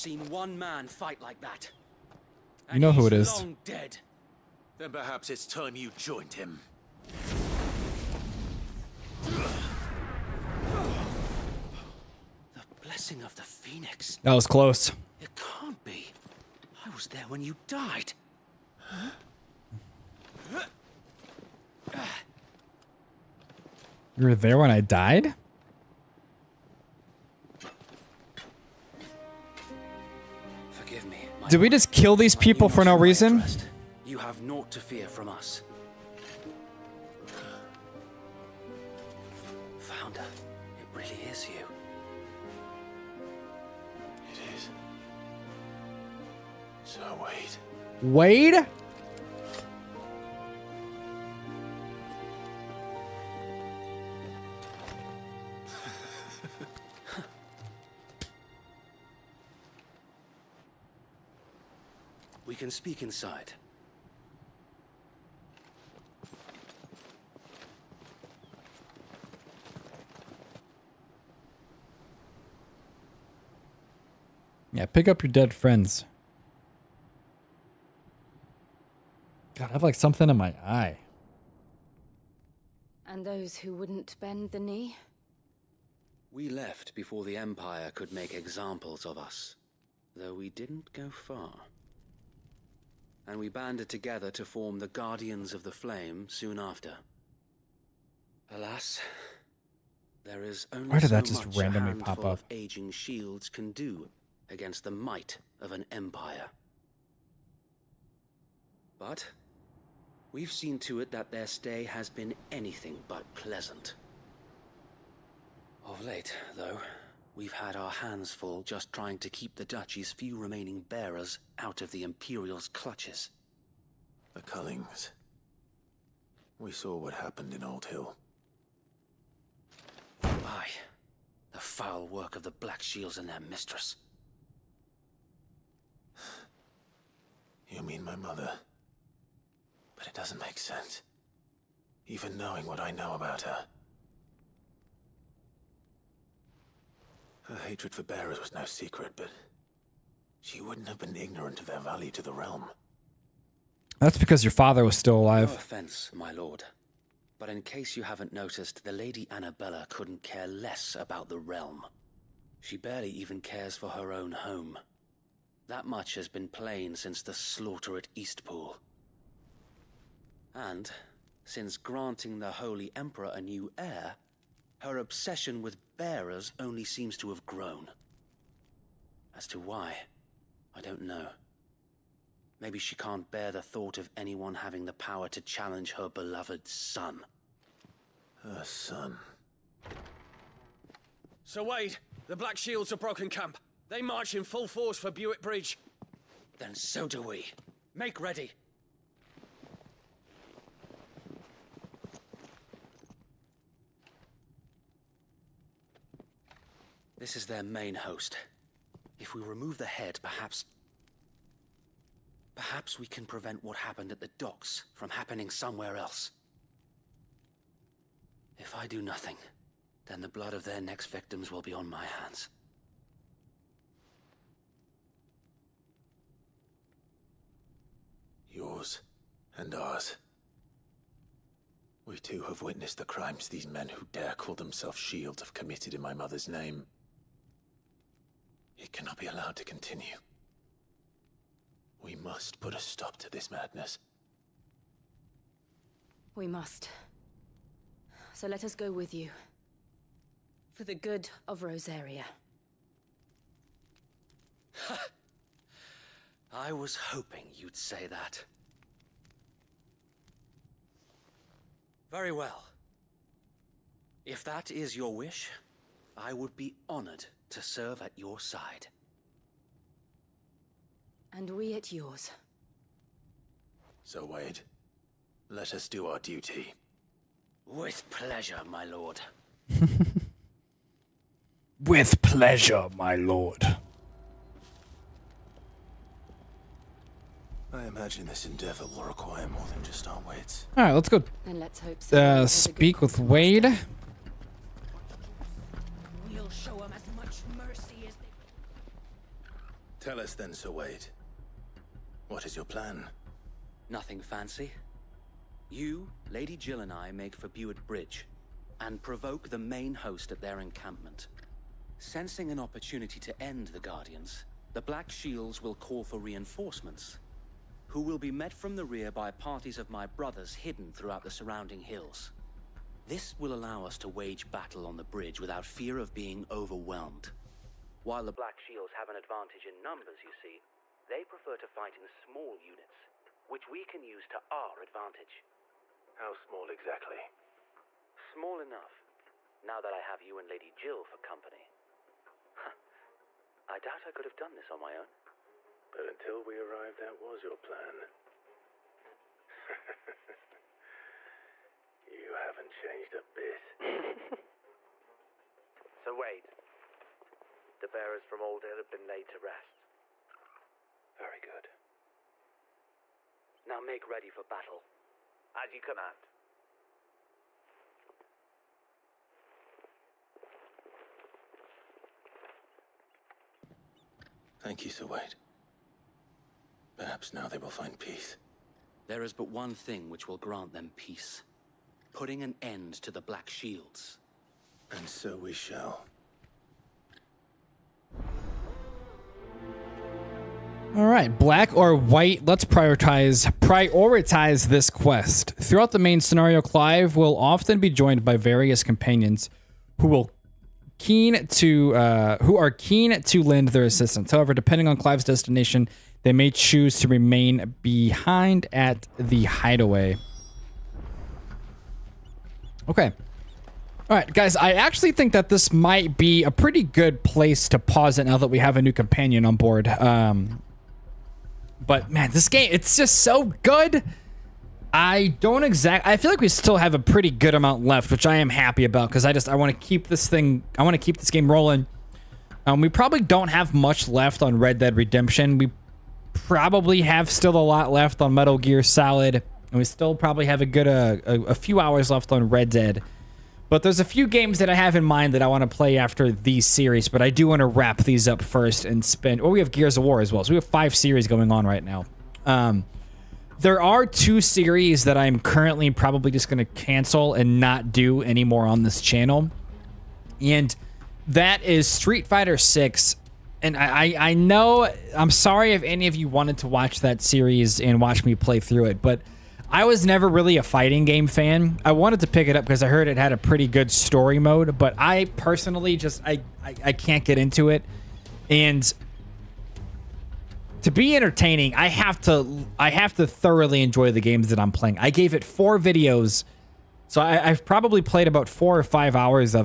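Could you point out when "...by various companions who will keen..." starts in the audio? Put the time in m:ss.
6:38.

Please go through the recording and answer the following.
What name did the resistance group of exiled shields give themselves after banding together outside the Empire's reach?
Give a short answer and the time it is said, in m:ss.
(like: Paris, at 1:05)
Guardians of the Flame, at 1:34.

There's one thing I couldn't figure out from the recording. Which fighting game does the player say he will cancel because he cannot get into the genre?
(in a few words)
Street Fighter Six.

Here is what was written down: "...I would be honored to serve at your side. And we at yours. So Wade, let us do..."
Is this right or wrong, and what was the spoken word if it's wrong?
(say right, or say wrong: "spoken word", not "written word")
right.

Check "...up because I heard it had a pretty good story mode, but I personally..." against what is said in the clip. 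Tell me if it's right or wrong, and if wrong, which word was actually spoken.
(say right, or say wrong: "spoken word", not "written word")
right.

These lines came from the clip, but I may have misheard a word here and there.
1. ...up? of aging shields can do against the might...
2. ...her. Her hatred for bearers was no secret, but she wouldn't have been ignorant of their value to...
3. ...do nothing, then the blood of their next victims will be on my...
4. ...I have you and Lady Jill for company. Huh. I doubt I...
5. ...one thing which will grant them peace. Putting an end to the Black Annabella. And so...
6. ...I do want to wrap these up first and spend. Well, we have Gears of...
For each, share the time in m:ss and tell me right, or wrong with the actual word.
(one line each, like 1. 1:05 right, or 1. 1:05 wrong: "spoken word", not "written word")
1. 1:42 right
2. 2:23 right
3. 3:38 right
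4. 5:39 right
5. 6:19 wrong: "Shields", not "Annabella"
6. 7:27 right.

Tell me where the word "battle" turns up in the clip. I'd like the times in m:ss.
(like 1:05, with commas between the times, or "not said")
5:24, 6:04.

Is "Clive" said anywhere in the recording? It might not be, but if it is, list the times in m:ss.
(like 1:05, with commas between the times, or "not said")
6:36, 6:44.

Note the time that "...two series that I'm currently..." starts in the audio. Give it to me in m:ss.
7:34.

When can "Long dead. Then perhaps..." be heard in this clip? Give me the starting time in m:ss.
0:03.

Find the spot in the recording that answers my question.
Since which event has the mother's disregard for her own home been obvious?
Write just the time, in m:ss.
2:47.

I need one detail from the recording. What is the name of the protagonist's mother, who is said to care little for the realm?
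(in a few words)
Annabella.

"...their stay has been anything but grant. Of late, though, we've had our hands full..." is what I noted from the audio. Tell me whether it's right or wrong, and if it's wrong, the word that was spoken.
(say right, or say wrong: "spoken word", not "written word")
wrong: "pleasant", not "grant".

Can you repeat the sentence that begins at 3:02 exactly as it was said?
Maybe she can't bear the thought of anyone having the power to challenge her beloved son.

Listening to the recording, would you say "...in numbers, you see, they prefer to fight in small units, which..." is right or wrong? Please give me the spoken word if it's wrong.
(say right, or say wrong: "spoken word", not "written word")
right.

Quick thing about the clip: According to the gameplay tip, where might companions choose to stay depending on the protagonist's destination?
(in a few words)
the hideaway.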